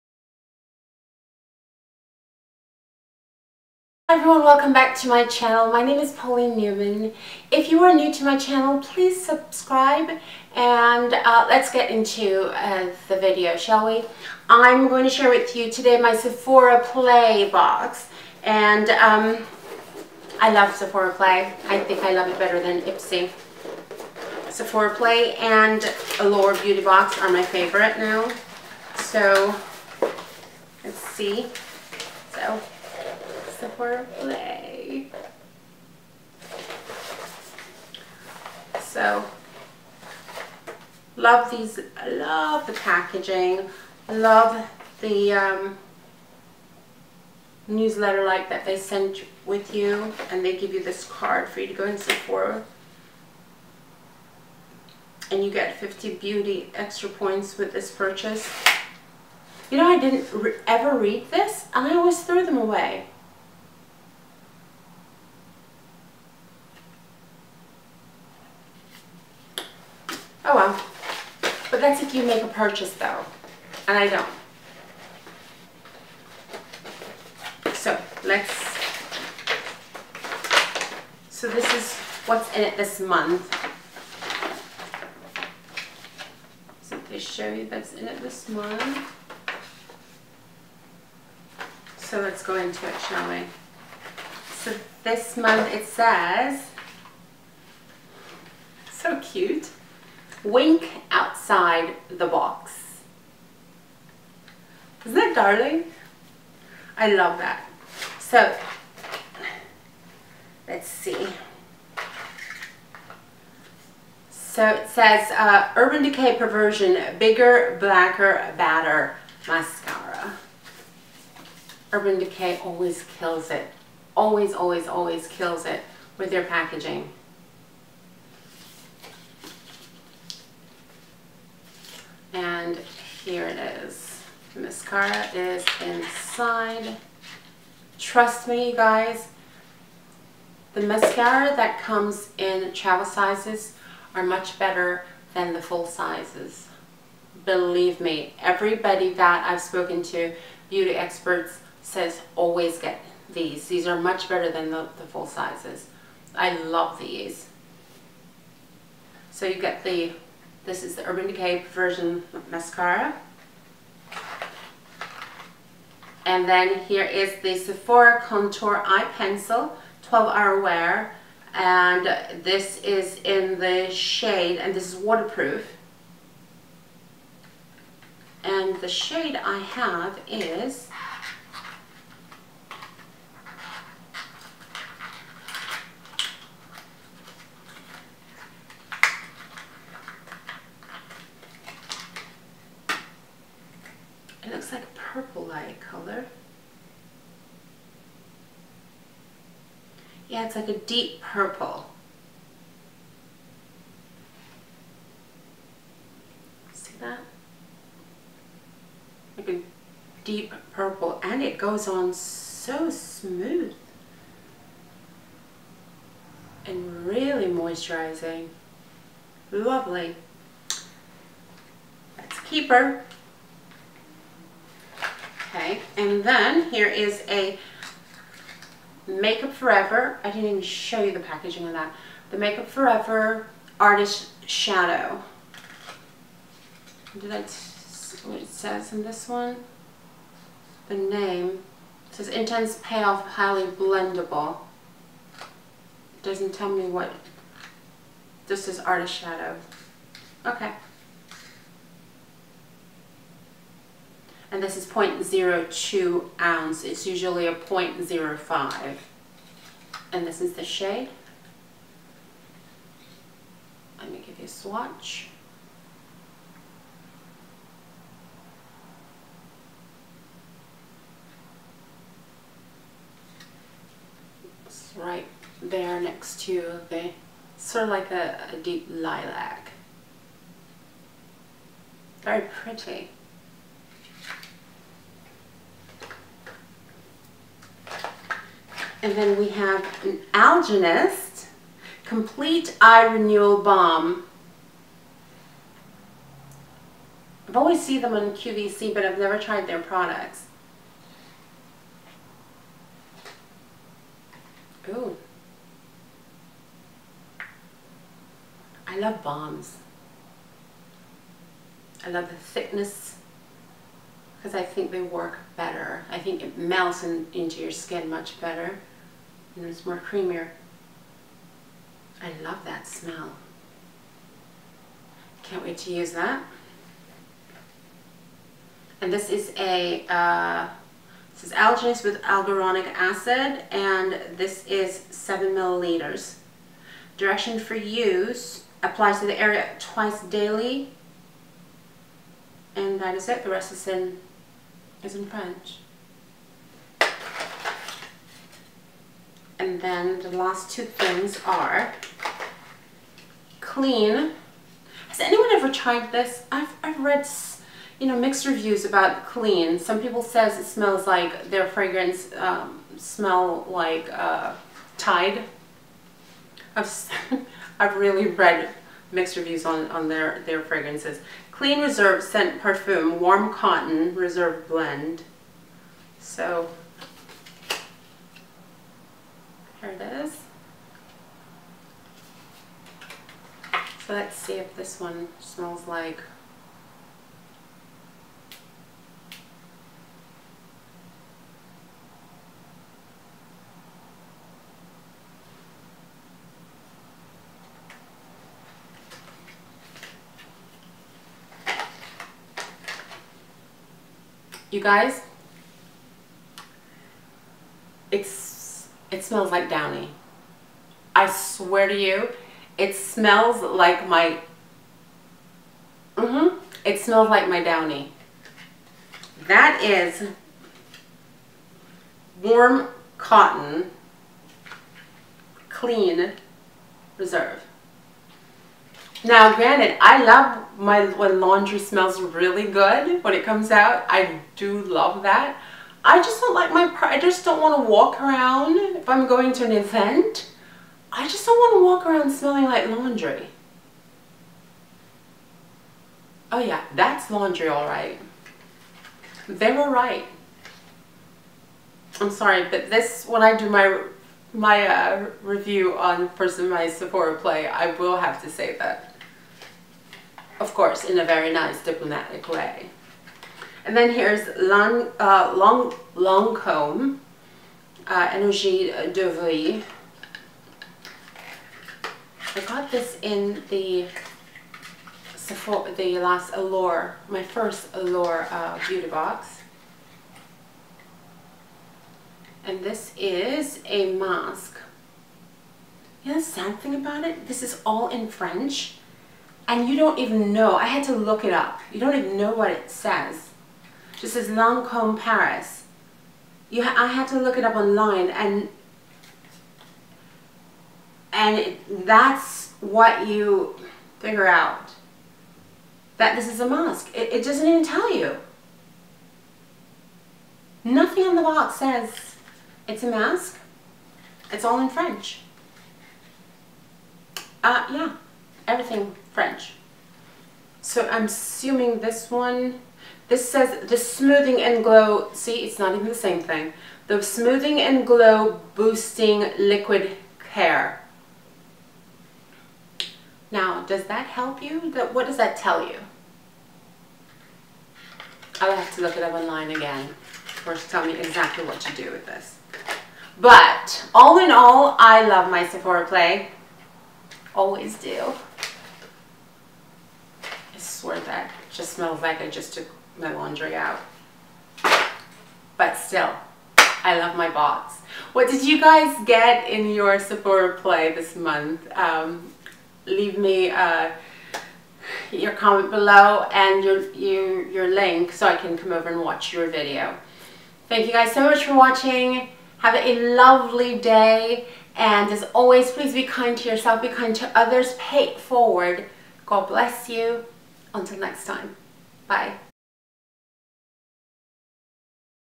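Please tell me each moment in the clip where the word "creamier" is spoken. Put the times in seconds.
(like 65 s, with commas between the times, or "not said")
320 s.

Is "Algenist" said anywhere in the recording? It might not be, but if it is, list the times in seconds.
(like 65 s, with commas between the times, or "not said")
290 s, 331 s.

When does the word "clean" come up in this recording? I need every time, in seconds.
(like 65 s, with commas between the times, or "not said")
353 s, 359 s, 371 s, 425 s.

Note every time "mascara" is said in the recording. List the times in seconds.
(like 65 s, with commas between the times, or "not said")
119 s, 134 s, 140 s, 162 s.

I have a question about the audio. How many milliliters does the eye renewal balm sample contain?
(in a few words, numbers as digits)
7.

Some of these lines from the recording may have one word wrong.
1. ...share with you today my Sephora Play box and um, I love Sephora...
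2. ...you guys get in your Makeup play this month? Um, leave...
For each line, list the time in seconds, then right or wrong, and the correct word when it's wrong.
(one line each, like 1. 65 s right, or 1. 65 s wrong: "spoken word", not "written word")
1. 15 s right
2. 558 s wrong: "Sephora", not "Makeup".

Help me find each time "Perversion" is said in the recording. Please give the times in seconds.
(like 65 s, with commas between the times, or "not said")
116 s, 161 s.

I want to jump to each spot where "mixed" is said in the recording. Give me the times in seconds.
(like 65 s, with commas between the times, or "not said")
358 s, 369 s.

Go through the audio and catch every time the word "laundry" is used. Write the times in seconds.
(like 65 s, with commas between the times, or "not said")
431 s, 442 s, 447 s, 553 s.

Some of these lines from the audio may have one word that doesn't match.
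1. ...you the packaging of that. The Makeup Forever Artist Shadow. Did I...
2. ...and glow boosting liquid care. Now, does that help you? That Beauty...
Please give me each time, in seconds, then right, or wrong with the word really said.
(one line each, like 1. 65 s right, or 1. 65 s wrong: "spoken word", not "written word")
1. 231 s right
2. 527 s wrong: "What", not "Beauty".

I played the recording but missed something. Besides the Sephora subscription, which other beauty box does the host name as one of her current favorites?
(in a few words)
Allure Beauty Box.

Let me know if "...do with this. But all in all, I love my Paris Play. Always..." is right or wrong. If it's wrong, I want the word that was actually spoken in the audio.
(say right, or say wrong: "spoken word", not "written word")
wrong: "Sephora", not "Paris".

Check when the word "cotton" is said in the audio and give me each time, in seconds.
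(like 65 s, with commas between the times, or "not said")
373 s, 423 s.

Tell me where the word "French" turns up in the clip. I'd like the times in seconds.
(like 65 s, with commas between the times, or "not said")
345 s, 488 s, 514 s, 519 s.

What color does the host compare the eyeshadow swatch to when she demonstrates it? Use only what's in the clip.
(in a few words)
deep lilac.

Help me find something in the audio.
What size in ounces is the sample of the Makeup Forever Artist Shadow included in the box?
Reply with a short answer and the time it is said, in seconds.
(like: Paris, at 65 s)
0.02 ounce, at 254 s.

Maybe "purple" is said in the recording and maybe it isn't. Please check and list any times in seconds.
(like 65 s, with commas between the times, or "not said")
201 s, 210 s.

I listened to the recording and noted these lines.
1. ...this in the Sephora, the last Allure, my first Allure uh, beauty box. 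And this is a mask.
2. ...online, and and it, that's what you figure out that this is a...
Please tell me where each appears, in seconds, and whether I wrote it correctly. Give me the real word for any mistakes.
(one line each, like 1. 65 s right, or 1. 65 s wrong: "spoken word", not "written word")
1. 472 s right
2. 497 s right.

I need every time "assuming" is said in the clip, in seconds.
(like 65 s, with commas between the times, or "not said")
521 s.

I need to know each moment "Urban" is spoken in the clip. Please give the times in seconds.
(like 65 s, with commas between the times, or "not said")
115 s, 121 s, 161 s.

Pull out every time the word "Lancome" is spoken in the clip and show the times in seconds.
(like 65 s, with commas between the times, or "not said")
466 s, 494 s.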